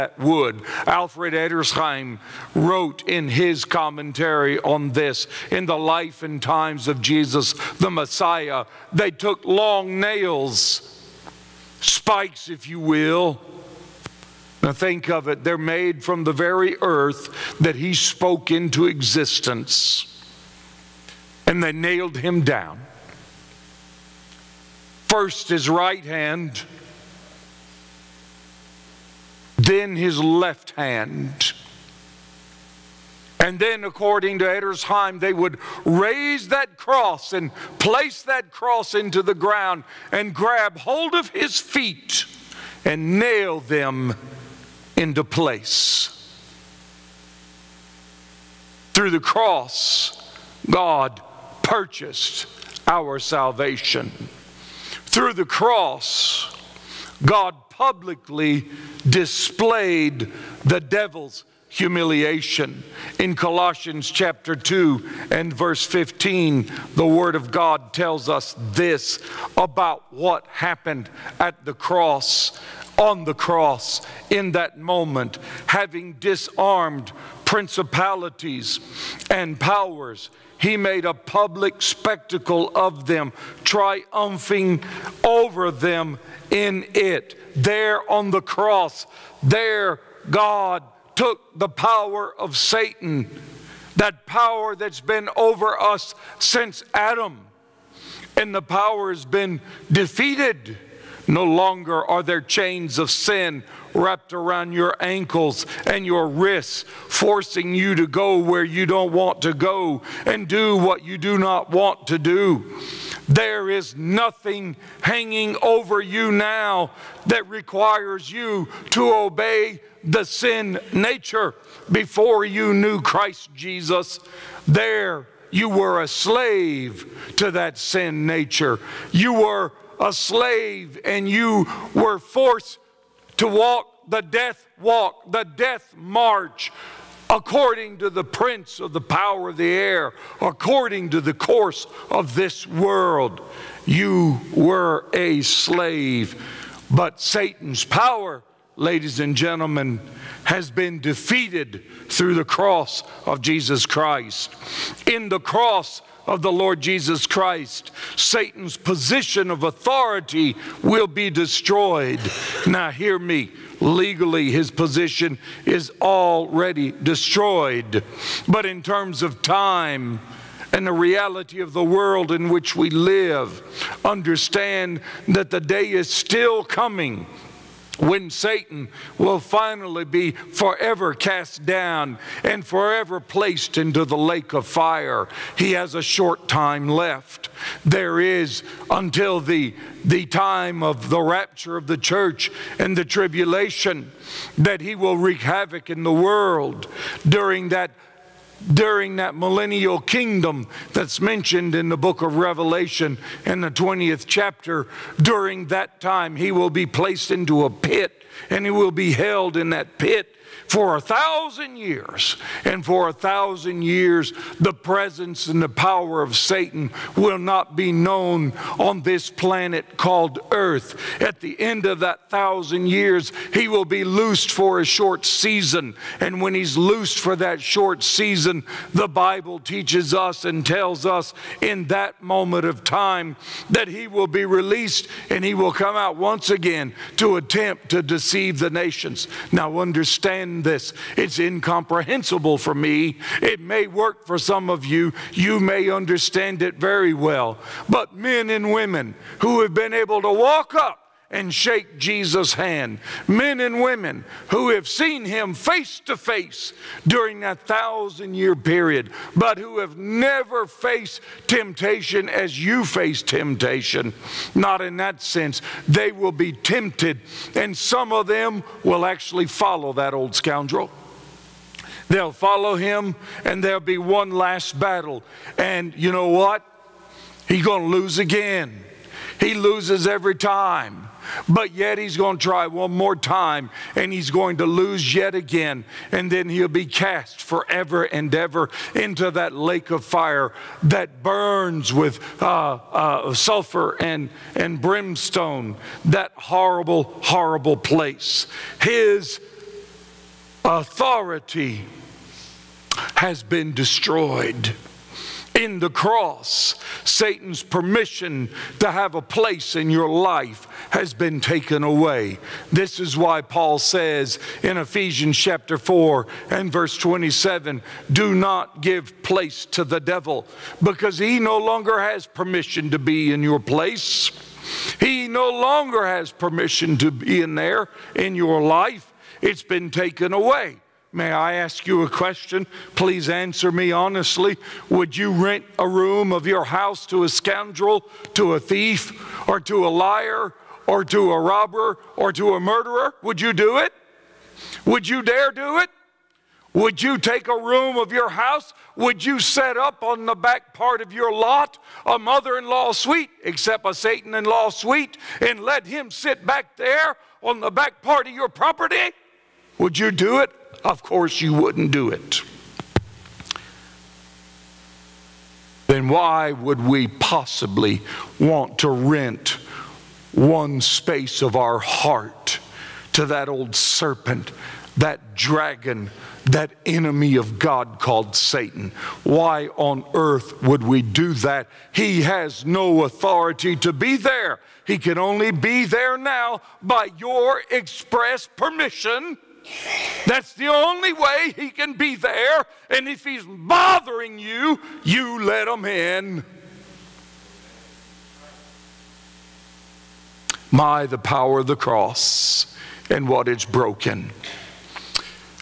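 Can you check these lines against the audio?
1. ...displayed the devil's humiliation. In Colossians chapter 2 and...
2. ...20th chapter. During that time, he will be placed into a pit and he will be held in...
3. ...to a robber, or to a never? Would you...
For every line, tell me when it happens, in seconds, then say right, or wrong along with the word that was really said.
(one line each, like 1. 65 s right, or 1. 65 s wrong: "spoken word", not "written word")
1. 59 s right
2. 203 s right
3. 341 s wrong: "murderer", not "never".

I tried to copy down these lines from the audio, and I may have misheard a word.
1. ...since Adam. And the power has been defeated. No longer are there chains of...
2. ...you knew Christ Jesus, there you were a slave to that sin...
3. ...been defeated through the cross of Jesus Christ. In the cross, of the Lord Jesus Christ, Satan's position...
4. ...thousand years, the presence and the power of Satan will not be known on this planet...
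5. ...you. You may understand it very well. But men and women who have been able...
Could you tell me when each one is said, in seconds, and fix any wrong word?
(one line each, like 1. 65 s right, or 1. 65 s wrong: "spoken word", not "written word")
1. 96 s right
2. 122 s right
3. 150 s right
4. 213 s right
5. 244 s right.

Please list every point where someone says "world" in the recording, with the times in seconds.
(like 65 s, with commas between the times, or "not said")
142 s, 171 s, 196 s.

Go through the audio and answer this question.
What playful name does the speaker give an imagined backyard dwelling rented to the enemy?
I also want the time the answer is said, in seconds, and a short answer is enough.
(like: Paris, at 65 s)
Satan in law suite, at 353 s.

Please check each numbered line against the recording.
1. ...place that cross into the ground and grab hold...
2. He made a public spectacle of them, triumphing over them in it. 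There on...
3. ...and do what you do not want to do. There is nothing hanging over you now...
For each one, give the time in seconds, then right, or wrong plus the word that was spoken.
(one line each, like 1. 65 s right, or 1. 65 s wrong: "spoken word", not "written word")
1. 37 s right
2. 80 s right
3. 110 s right.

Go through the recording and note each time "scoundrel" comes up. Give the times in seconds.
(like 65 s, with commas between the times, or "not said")
270 s, 337 s.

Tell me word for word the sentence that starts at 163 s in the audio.
Legally, his position is already destroyed.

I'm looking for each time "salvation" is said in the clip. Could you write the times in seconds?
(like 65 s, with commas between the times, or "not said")
53 s.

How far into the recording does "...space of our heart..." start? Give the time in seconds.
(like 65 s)
370 s.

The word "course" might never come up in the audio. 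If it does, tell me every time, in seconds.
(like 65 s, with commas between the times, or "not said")
141 s, 361 s.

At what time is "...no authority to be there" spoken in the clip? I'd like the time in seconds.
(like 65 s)
382 s.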